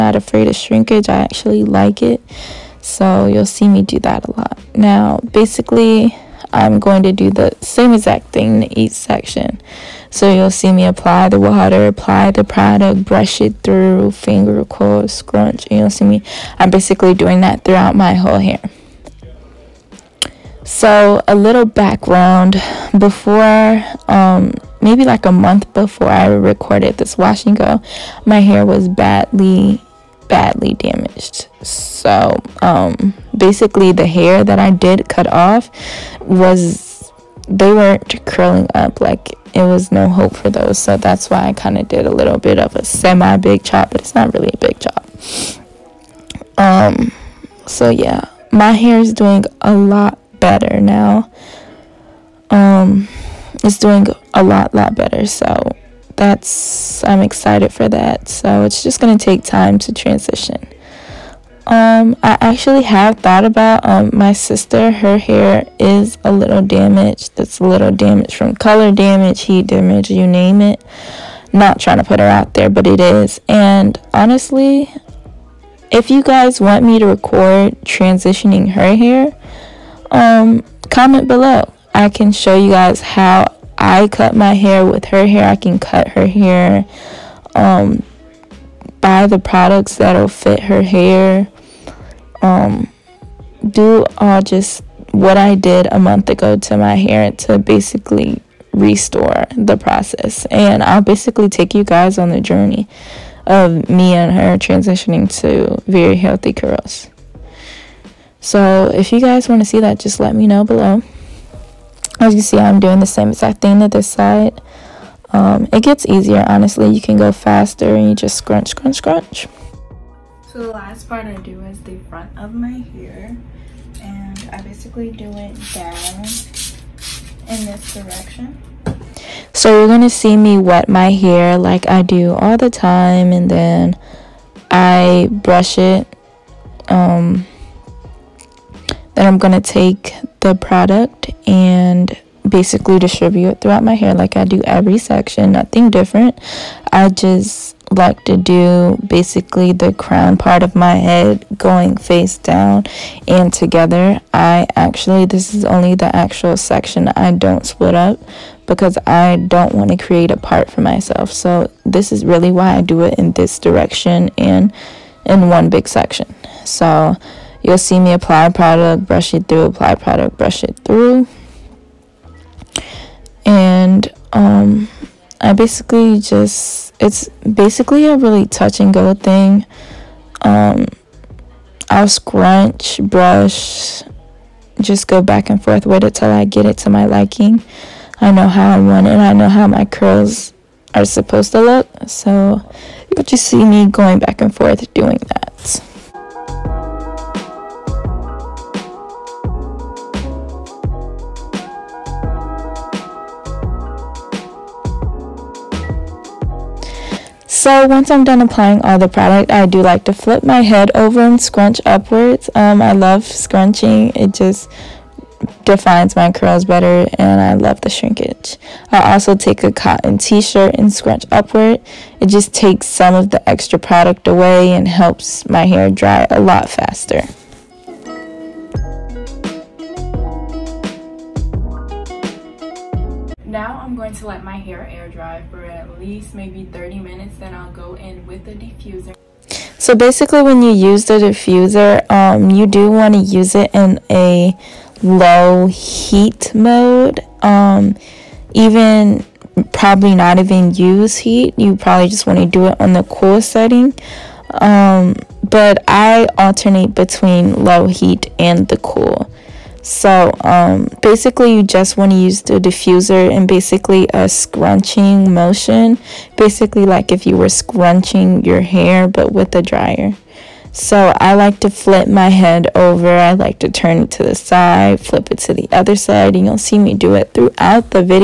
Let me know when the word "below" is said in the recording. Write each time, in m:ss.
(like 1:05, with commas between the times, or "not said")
1:21, 1:50.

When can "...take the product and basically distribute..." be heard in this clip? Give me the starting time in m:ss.
2:19.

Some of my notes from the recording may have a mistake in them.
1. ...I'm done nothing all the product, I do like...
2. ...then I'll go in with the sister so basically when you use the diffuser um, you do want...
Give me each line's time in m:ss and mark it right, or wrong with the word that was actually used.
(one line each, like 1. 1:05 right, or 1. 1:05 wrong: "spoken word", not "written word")
1. 3:28 wrong: "applying", not "nothing"
2. 3:57 wrong: "diffuser", not "sister".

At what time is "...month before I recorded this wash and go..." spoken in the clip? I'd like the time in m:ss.
0:25.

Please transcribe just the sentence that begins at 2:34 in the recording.
I actually, this is only the actual section I don't split up because I don't want to create a part for myself.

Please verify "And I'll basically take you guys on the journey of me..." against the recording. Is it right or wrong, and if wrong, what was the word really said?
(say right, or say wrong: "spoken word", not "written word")
right.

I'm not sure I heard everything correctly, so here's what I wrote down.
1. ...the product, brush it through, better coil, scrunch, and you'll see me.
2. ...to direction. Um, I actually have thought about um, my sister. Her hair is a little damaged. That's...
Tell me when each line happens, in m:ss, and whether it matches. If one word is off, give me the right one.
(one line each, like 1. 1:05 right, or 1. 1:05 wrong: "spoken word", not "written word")
1. 0:12 wrong: "finger", not "better"
2. 0:59 wrong: "transition", not "direction".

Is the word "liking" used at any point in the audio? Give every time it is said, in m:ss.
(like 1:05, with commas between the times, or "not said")
3:07.